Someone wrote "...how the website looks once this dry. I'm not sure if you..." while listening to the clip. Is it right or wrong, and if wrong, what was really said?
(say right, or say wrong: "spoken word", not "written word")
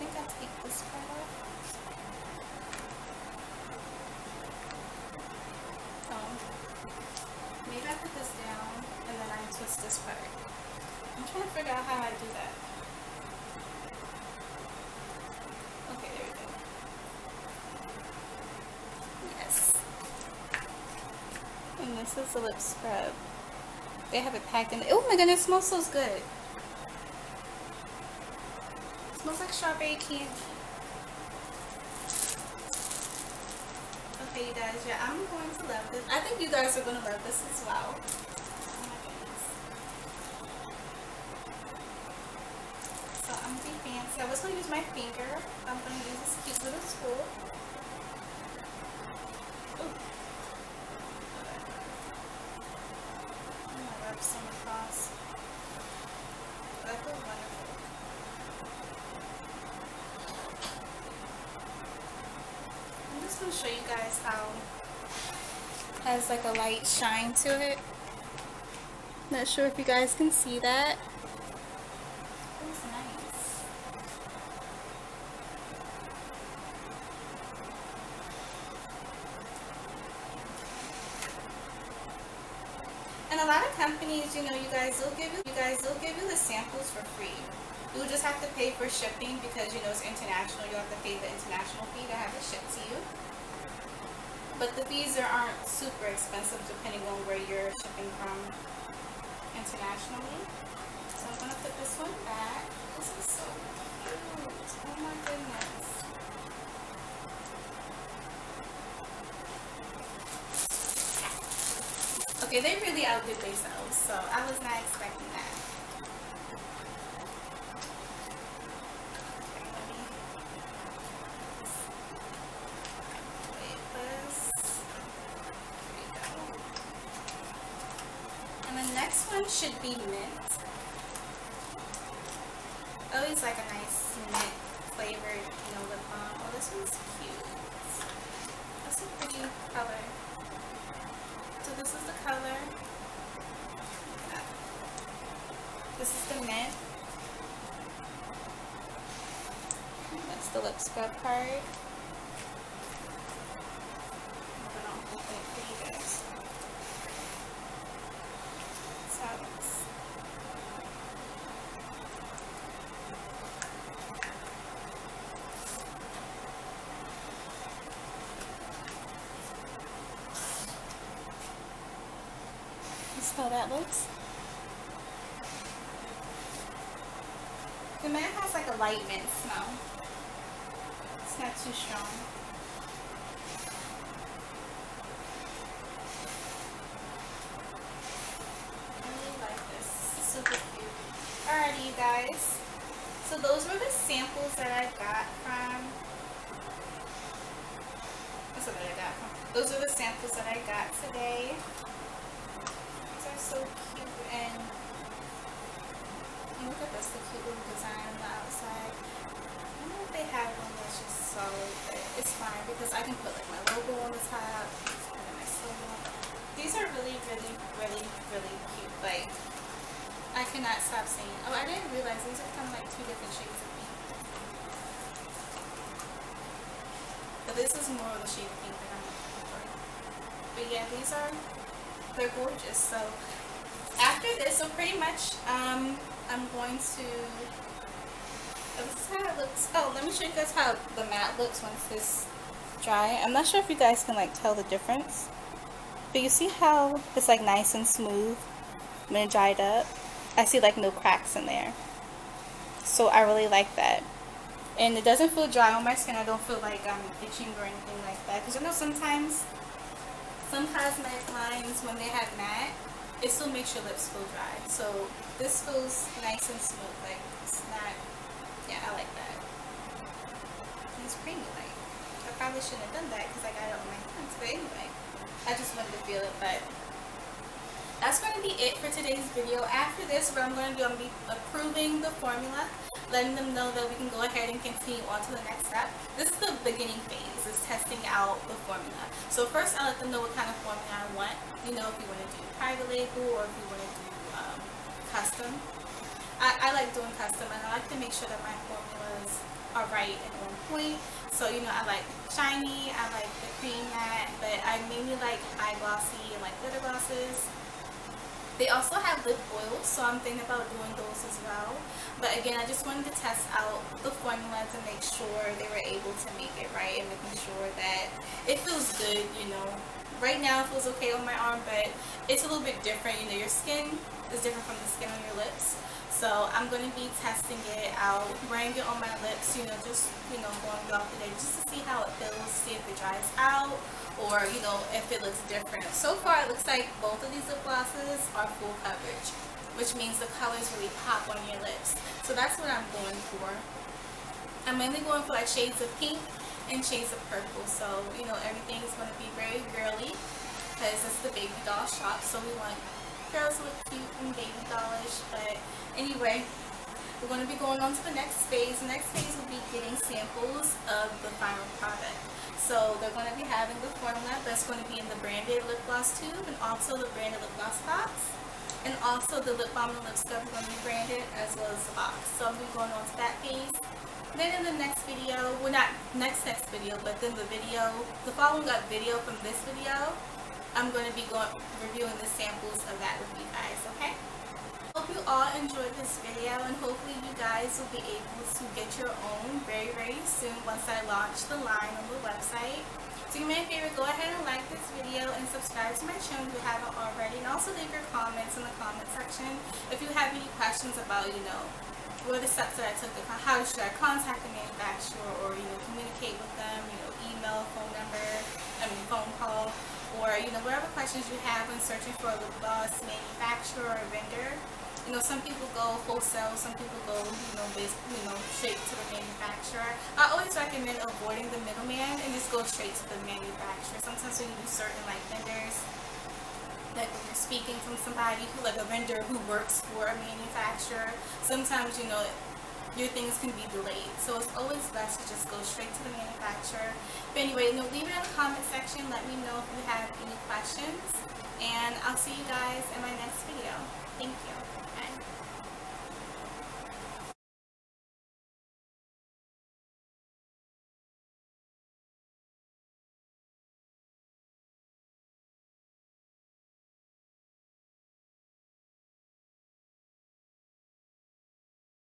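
wrong: "matte", not "website".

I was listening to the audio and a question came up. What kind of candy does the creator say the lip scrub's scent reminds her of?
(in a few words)
Strawberry candy.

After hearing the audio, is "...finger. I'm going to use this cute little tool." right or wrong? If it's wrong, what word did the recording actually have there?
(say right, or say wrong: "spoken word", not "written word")
right.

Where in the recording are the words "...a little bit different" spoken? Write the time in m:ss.
5:22.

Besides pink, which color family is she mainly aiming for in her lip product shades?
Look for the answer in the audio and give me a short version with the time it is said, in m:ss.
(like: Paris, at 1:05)
Purple, at 5:47.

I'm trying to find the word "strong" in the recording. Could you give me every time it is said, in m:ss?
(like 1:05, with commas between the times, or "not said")
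3:01.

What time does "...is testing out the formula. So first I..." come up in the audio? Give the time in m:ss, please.
4:47.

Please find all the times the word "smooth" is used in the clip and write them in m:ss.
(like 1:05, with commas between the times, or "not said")
4:07, 4:26.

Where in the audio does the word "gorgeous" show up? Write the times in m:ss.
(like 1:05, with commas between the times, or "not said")
3:52.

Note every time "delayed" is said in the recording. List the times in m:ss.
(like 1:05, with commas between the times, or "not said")
7:13.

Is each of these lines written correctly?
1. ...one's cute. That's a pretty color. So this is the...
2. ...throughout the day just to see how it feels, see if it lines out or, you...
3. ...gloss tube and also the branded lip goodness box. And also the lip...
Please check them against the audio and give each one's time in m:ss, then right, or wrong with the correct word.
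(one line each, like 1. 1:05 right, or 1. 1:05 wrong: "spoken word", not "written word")
1. 2:16 right
2. 5:30 wrong: "dries", not "lines"
3. 6:05 wrong: "gloss", not "goodness".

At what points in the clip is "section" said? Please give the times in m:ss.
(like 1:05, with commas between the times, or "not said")
6:39, 7:18.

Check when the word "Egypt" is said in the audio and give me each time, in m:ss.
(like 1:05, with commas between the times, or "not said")
not said.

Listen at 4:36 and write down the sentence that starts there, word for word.
But that's going to be it for today's video.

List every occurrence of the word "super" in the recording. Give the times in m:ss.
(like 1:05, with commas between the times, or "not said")
1:35, 3:10.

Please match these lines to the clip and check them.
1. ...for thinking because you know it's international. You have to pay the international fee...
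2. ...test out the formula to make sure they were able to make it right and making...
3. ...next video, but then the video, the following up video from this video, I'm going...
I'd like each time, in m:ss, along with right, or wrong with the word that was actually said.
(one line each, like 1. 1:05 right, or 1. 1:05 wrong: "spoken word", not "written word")
1. 1:28 wrong: "shipping", not "thinking"
2. 5:13 right
3. 6:16 right.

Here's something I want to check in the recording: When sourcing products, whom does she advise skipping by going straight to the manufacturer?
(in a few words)
The middleman.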